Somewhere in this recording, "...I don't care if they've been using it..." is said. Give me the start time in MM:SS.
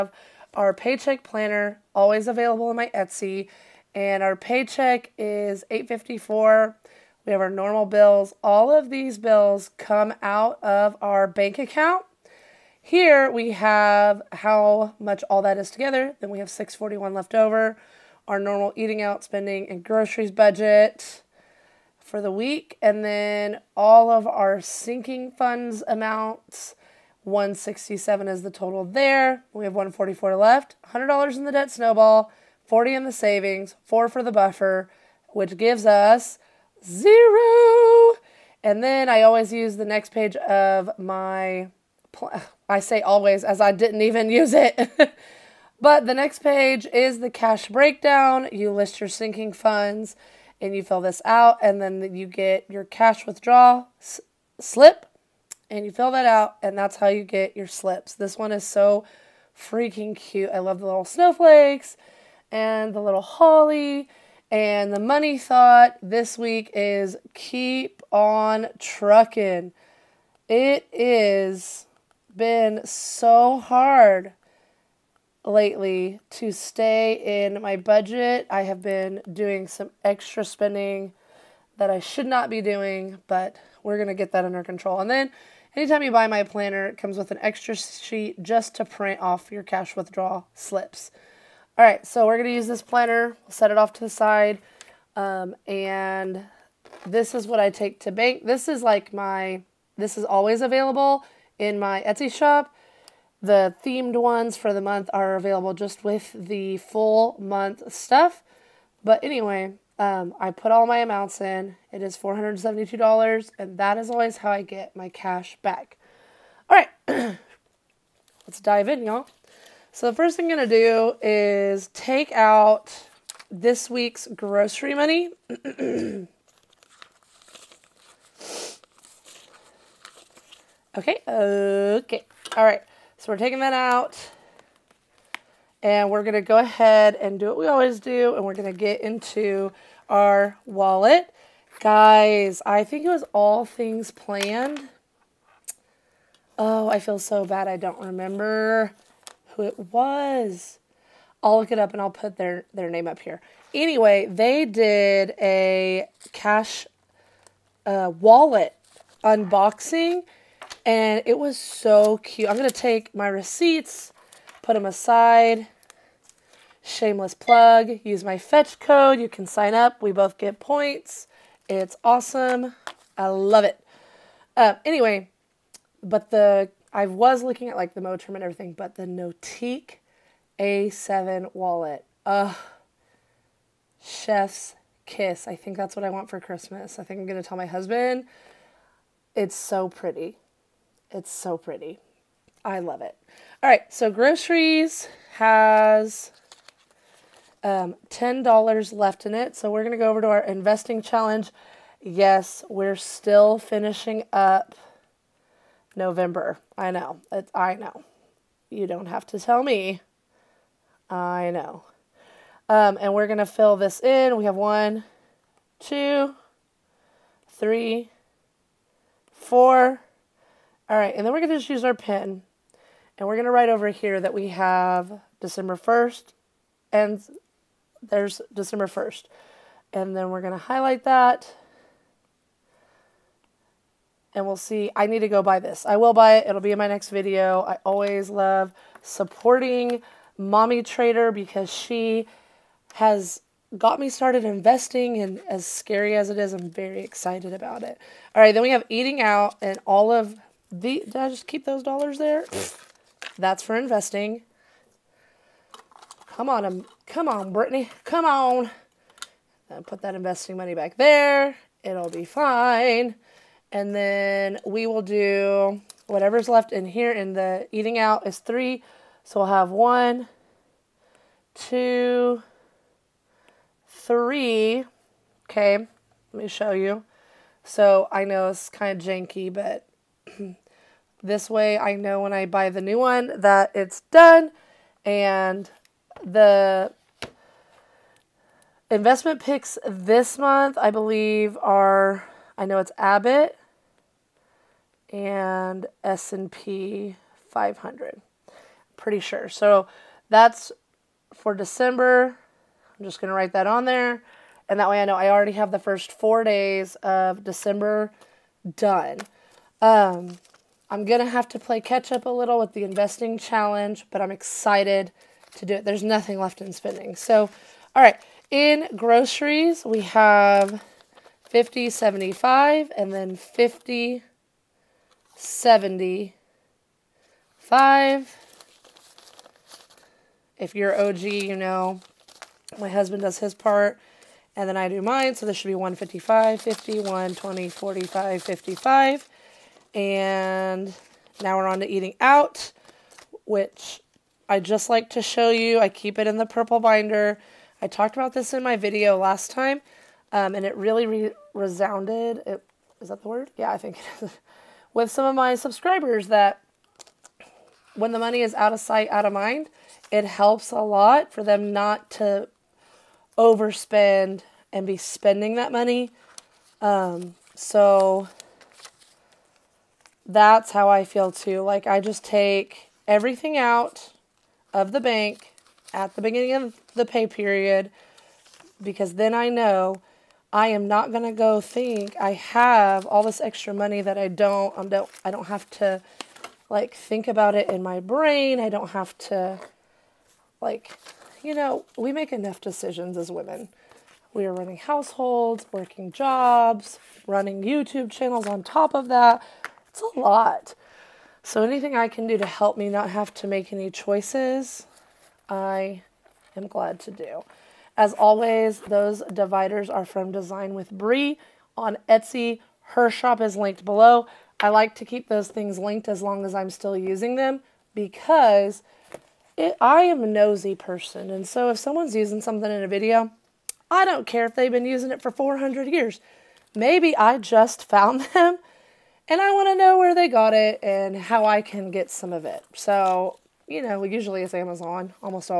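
07:03.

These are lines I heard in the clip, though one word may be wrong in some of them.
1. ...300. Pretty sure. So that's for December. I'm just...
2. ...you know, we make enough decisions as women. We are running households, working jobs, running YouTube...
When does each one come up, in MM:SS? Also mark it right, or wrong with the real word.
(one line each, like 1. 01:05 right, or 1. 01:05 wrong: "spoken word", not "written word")
1. 04:57 wrong: "500", not "300"
2. 06:31 right.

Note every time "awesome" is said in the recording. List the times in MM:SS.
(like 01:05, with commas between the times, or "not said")
02:52.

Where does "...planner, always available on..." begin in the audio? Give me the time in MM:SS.
00:01.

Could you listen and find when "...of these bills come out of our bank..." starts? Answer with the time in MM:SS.
00:08.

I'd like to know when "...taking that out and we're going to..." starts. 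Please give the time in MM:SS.
02:13.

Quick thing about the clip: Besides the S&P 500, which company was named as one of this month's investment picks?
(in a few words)
Abbott.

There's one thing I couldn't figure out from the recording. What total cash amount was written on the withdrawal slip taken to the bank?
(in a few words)
$472.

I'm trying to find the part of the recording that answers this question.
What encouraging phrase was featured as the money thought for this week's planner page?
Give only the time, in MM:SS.
01:07.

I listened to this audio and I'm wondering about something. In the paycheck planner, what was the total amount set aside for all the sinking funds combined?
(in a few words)
167.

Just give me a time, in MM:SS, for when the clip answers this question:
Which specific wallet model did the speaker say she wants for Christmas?
02:59.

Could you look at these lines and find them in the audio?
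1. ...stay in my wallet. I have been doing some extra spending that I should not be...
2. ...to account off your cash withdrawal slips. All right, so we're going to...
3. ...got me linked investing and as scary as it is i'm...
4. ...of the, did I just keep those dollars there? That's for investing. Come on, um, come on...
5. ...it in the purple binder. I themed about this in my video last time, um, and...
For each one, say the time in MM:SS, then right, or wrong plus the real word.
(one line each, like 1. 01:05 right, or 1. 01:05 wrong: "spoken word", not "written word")
1. 01:16 wrong: "budget", not "wallet"
2. 01:28 wrong: "print", not "account"
3. 04:03 wrong: "started", not "linked"
4. 04:10 right
5. 05:46 wrong: "talked", not "themed".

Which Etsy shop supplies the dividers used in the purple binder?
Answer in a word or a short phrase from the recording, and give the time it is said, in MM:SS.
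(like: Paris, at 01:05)
Design with Bree, at 06:50.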